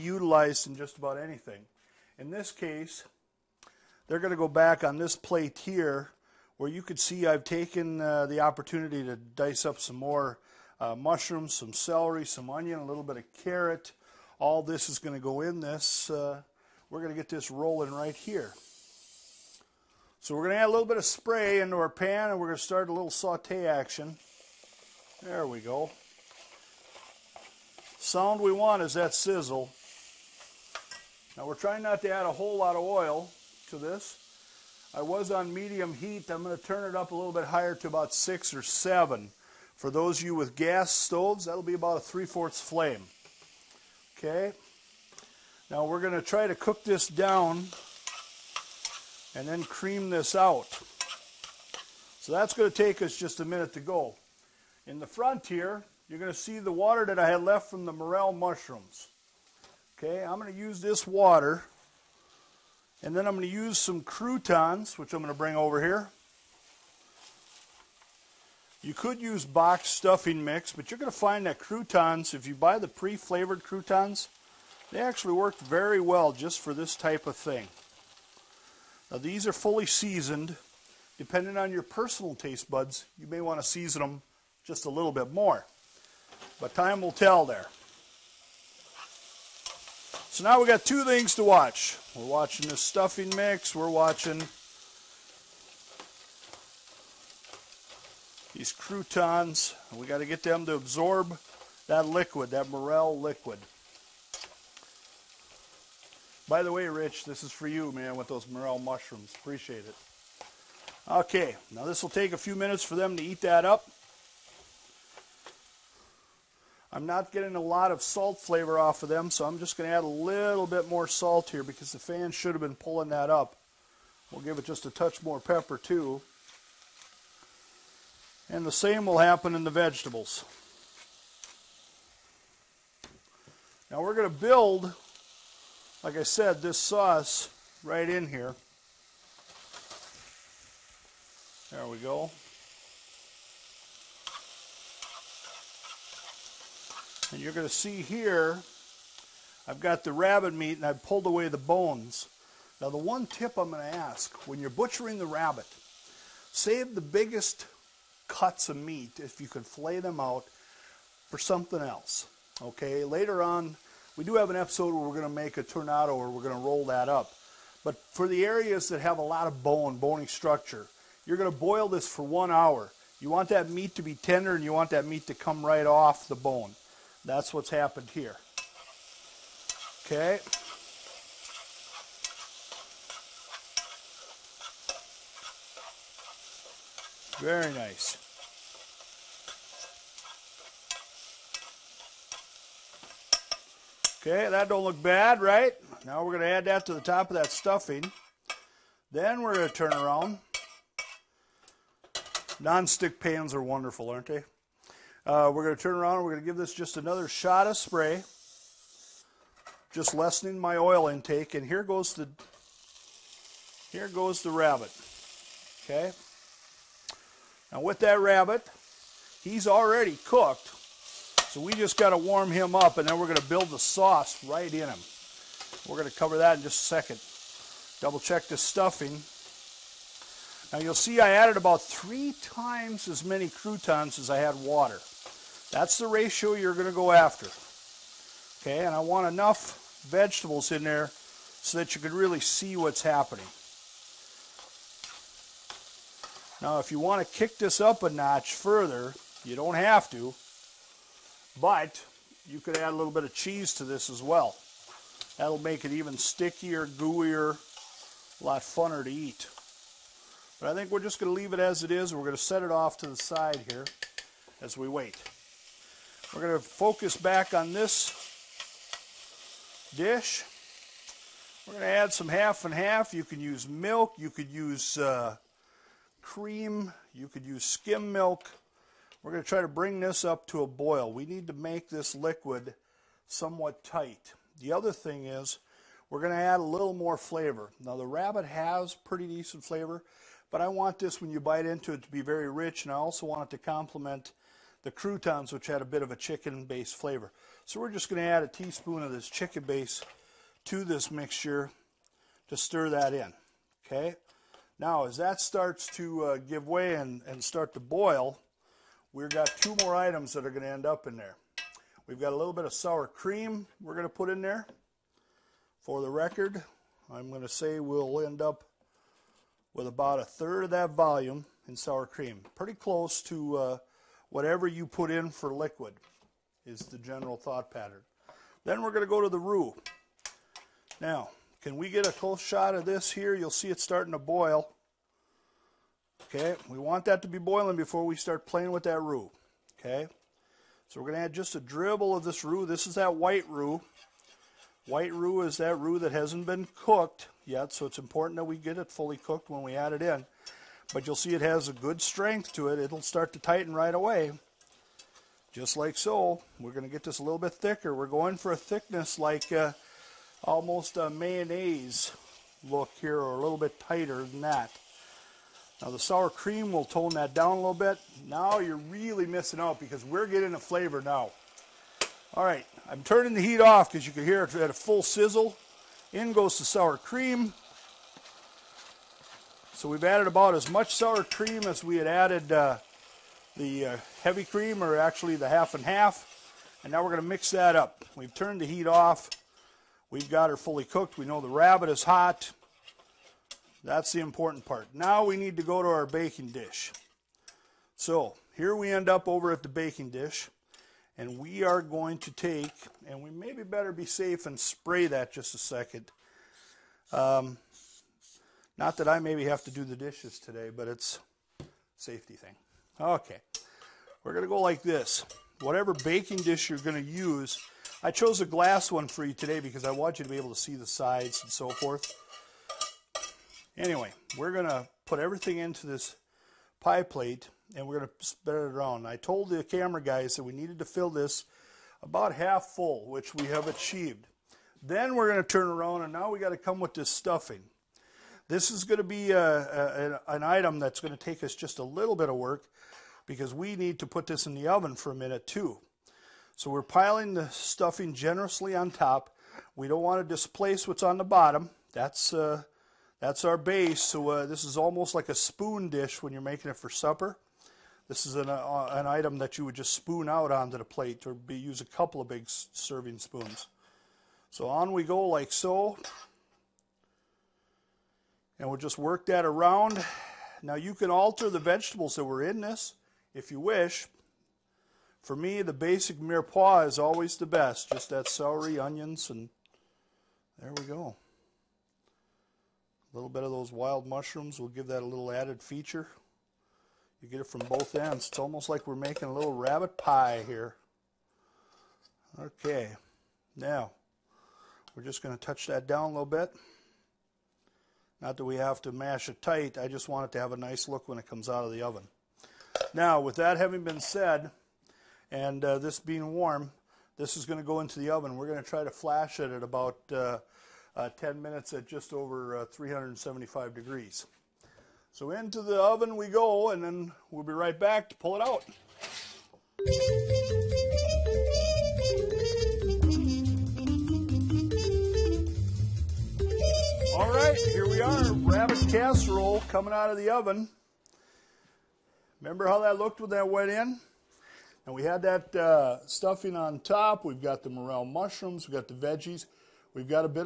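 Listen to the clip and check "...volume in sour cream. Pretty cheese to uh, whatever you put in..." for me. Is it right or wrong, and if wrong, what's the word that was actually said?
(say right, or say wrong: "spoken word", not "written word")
wrong: "close", not "cheese".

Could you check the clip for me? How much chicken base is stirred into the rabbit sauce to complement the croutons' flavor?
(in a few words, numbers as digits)
a teaspoon.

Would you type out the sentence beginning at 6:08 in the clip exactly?
Now you're really missing out because we're getting a flavor now.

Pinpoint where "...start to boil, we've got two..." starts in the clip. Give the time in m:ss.
5:07.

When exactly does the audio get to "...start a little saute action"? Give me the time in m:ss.
0:22.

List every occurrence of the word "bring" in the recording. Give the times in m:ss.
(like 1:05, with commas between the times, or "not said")
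1:05, 4:39.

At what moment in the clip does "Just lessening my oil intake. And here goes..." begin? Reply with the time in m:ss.
3:29.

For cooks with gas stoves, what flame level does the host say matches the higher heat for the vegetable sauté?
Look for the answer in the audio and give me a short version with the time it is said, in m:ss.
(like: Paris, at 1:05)
three-fourths flame, at 0:41.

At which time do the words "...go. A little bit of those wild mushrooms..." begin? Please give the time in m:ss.
8:00.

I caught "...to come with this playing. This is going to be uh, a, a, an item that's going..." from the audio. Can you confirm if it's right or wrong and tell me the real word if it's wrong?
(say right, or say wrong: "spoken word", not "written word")
wrong: "stuffing", not "playing".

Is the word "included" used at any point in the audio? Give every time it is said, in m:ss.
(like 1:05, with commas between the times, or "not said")
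not said.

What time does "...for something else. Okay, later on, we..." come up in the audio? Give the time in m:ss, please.
2:41.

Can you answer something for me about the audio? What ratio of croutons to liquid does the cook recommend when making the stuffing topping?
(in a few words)
3 times as many.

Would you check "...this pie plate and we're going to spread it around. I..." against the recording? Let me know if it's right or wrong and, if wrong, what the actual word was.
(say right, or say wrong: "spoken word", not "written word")
right.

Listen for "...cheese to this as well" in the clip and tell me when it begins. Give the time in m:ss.
4:13.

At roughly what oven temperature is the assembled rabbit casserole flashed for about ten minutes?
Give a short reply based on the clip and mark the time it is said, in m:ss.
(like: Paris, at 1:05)
375 degrees, at 8:32.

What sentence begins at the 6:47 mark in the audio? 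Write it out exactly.
Um, not that I maybe have to do the dishes today, but it's safety thing.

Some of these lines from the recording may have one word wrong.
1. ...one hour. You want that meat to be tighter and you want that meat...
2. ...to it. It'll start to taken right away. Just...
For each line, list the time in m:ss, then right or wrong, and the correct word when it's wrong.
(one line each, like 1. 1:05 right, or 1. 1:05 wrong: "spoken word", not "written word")
1. 2:52 wrong: "tender", not "tighter"
2. 5:52 wrong: "tighten", not "taken".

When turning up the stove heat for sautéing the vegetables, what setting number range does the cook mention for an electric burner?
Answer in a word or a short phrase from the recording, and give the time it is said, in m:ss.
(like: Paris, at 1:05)
6 or 7, at 0:38.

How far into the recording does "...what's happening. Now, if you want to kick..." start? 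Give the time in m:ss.
4:02.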